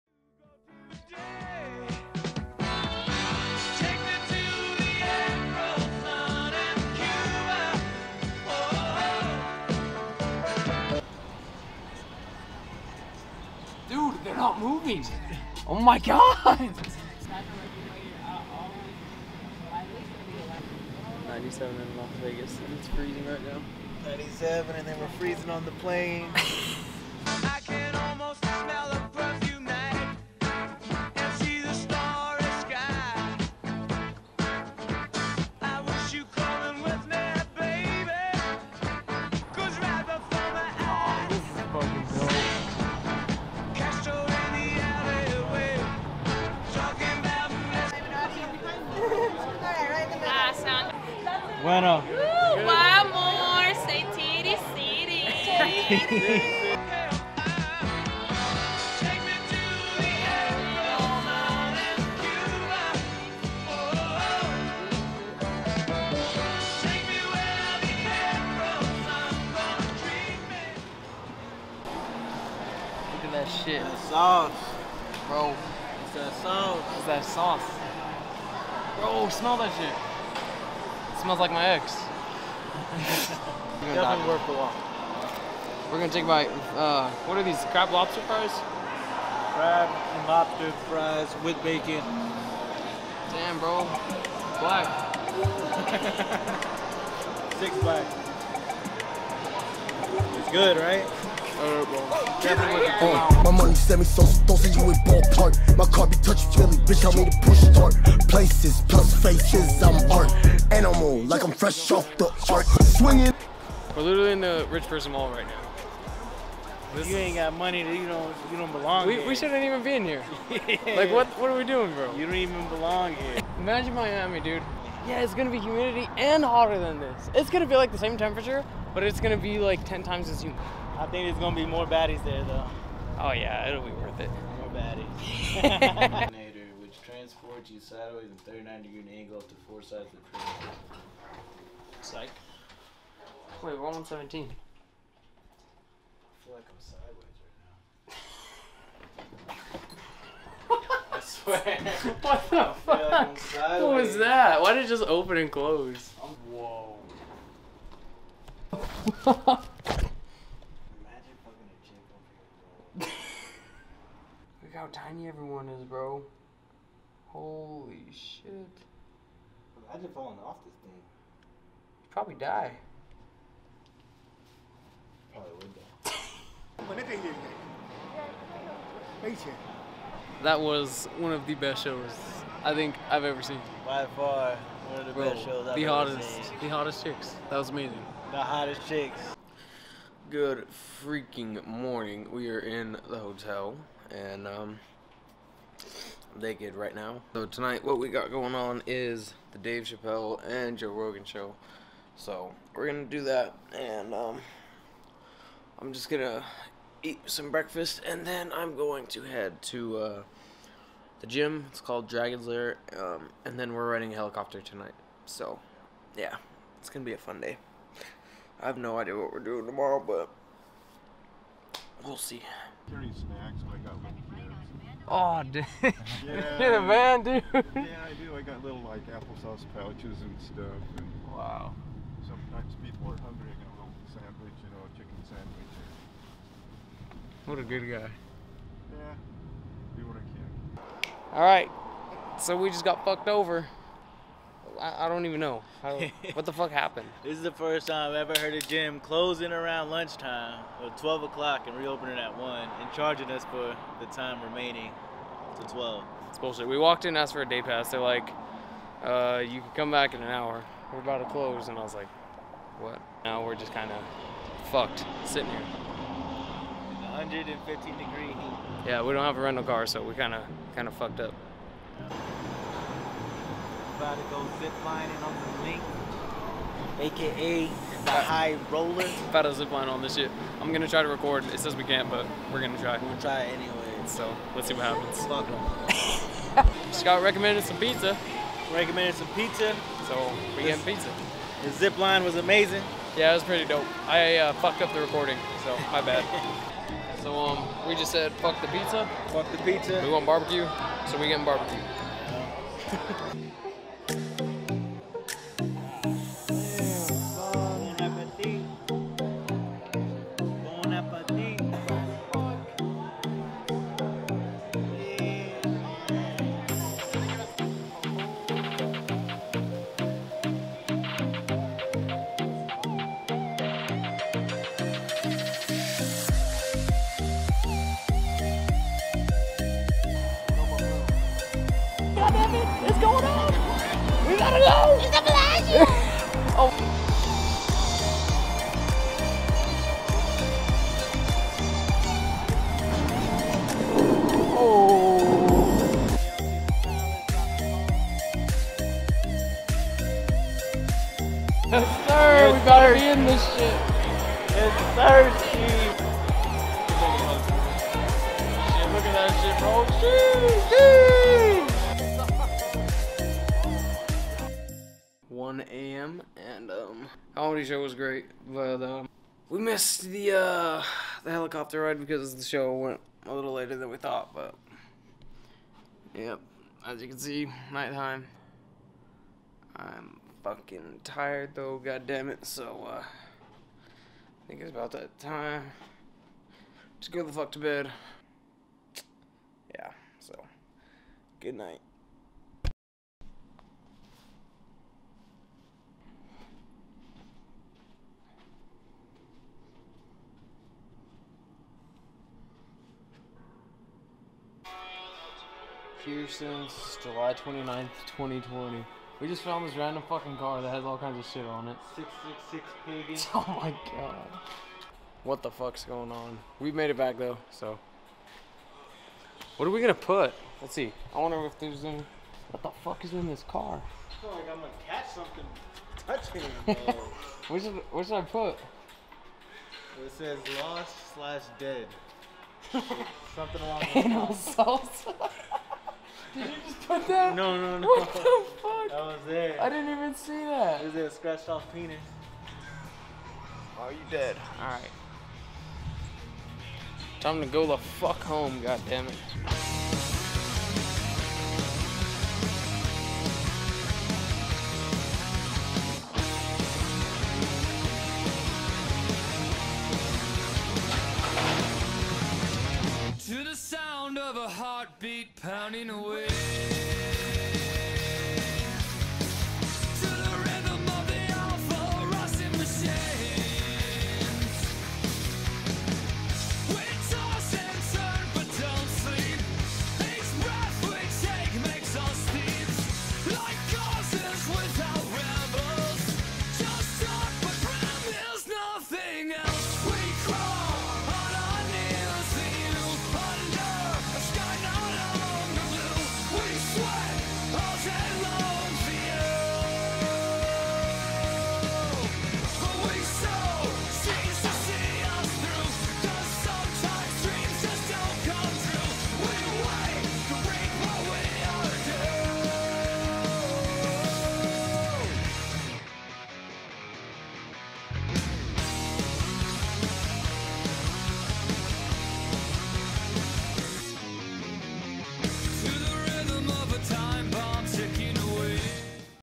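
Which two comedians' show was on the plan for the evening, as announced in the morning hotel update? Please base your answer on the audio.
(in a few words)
Dave Chappelle and Joe Rogan.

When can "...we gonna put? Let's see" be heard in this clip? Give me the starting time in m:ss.
6:59.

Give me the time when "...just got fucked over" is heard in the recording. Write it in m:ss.
4:02.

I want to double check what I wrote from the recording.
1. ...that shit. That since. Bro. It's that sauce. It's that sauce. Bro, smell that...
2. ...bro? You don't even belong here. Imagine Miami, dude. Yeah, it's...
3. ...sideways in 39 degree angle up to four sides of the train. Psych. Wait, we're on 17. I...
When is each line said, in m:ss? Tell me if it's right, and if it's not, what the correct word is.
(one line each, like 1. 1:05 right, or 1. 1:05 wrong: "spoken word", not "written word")
1. 1:13 wrong: "sauce", not "since"
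2. 2:01 right
3. 2:17 right.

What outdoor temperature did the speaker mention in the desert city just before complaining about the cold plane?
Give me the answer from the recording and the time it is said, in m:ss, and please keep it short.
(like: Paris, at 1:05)
97, at 0:21.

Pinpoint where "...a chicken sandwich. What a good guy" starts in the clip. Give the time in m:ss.
3:54.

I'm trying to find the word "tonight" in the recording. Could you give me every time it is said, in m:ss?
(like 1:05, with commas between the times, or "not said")
3:17, 3:34.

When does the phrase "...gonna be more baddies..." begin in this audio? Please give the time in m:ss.
2:11.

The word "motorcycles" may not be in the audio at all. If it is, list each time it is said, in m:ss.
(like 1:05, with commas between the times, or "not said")
not said.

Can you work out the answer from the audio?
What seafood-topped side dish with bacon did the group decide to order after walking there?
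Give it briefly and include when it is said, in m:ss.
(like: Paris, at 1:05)
Crab and lobster fries, at 1:29.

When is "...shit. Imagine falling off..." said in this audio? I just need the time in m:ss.
2:48.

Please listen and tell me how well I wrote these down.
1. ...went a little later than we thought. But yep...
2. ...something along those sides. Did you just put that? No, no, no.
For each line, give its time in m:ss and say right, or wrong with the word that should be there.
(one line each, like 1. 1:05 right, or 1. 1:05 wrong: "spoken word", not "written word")
1. 6:12 right
2. 7:13 wrong: "lines", not "sides".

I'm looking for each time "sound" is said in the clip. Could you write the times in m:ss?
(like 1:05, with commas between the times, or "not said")
7:44.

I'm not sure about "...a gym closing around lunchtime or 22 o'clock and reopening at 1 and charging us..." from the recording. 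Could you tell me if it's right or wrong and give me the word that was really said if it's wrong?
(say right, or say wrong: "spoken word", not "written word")
wrong: "12", not "22".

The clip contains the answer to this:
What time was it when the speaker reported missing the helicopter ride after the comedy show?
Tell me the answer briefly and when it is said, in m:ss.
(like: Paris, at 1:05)
1 a.m., at 6:05.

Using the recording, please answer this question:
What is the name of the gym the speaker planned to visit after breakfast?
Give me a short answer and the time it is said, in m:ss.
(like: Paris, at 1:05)
Dragon's Lair, at 3:32.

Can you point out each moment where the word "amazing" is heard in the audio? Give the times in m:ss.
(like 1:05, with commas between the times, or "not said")
3:07, 4:52.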